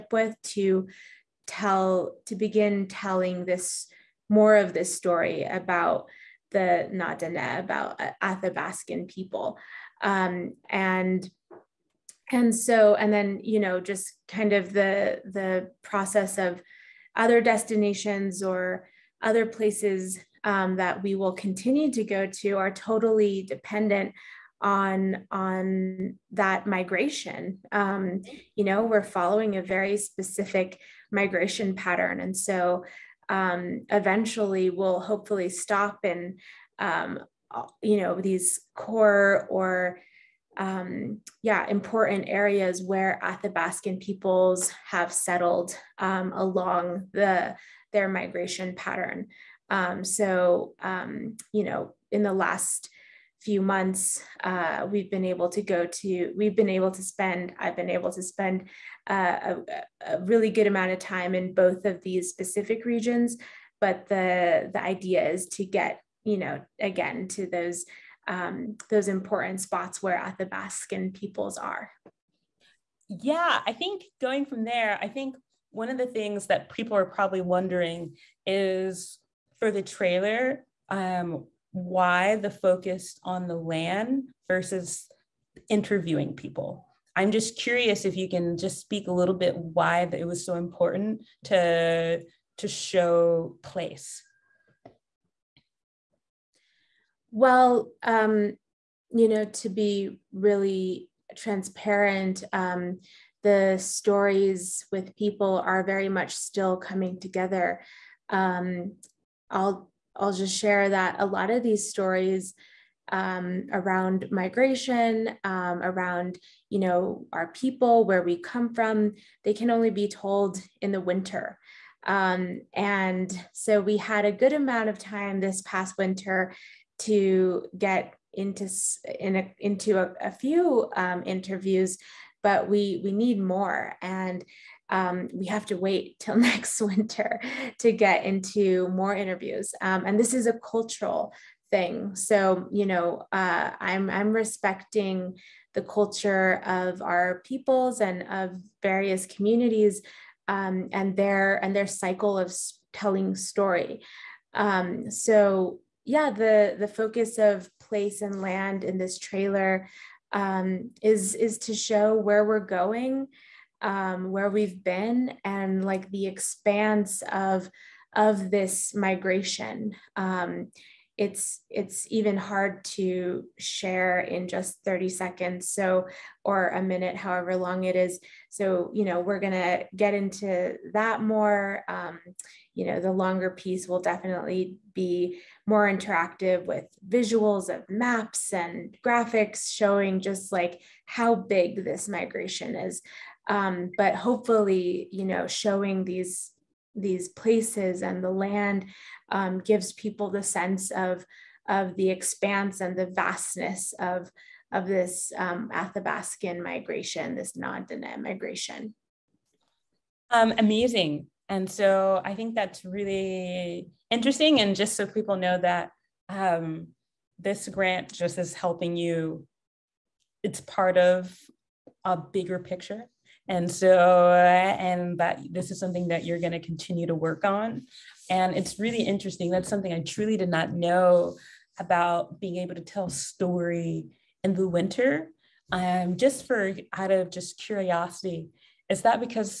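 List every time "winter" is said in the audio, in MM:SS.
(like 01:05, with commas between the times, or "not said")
02:01, 02:05, 02:16, 03:54.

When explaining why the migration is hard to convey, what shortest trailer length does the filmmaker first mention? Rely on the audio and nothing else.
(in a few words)
30 seconds.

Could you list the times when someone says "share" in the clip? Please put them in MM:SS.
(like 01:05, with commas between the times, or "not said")
01:50, 02:53.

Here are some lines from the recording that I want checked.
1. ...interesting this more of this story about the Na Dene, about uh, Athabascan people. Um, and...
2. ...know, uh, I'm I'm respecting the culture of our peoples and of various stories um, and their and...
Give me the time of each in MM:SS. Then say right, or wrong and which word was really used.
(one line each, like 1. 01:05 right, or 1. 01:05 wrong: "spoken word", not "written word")
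1. 00:02 wrong: "telling", not "interesting"
2. 02:22 wrong: "communities", not "stories".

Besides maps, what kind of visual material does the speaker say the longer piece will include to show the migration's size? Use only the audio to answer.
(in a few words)
Graphics.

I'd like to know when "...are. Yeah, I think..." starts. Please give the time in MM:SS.
01:11.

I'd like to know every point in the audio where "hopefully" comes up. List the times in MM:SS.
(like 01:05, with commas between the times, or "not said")
00:34, 03:14.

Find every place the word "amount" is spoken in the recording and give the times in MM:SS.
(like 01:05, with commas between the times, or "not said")
01:00, 02:04.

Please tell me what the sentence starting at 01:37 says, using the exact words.
Well, um, you know, to be really transparent, um, the stories with people are very much still coming together.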